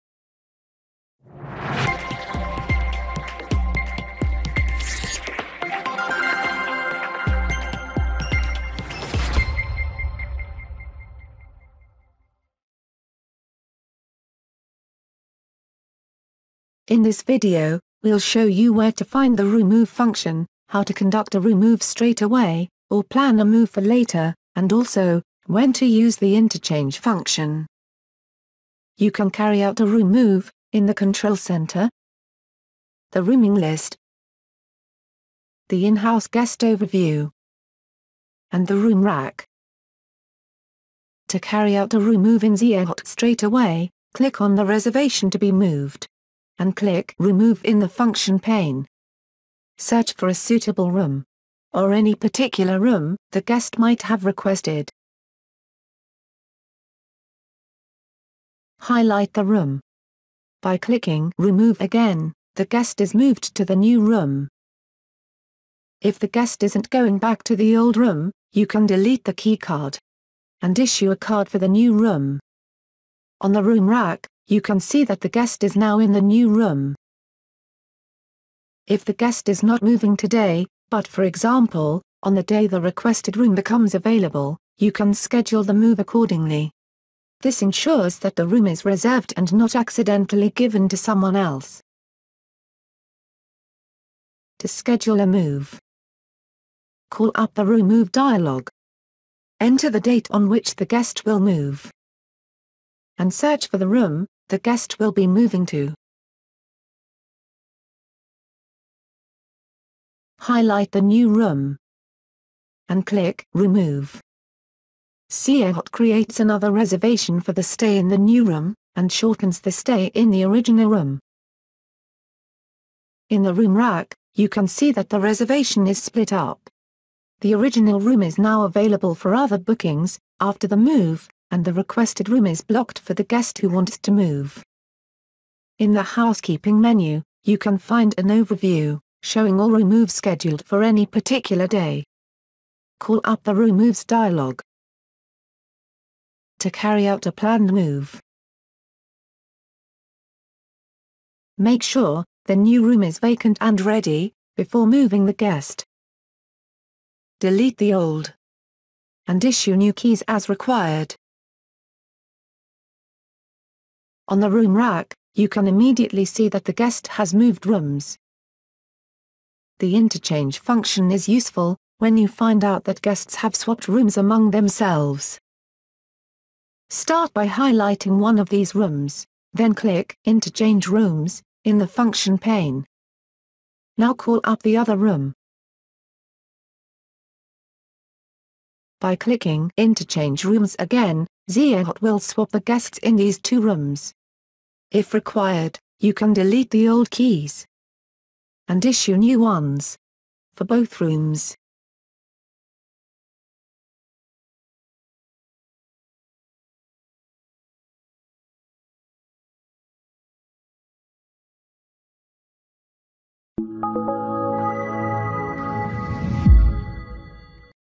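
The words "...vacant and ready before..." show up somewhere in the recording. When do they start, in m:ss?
2:33.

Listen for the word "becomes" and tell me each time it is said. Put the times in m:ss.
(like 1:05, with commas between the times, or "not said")
1:23.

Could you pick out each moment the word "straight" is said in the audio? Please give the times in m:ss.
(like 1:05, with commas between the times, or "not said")
0:21, 0:43.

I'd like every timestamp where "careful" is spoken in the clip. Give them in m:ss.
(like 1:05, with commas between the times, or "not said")
not said.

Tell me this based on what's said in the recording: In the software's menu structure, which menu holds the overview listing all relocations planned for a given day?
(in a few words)
housekeeping.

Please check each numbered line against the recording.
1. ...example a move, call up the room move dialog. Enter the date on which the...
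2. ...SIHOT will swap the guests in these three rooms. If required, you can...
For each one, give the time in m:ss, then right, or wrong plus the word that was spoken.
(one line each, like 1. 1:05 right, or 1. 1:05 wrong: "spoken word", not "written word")
1. 1:34 wrong: "schedule", not "example"
2. 3:11 wrong: "two", not "three".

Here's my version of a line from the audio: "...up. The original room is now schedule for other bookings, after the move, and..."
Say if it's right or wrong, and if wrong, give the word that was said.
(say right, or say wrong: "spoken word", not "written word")
wrong: "available", not "schedule".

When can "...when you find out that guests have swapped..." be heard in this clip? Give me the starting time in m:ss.
2:51.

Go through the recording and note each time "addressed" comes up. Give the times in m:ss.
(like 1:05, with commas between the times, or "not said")
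not said.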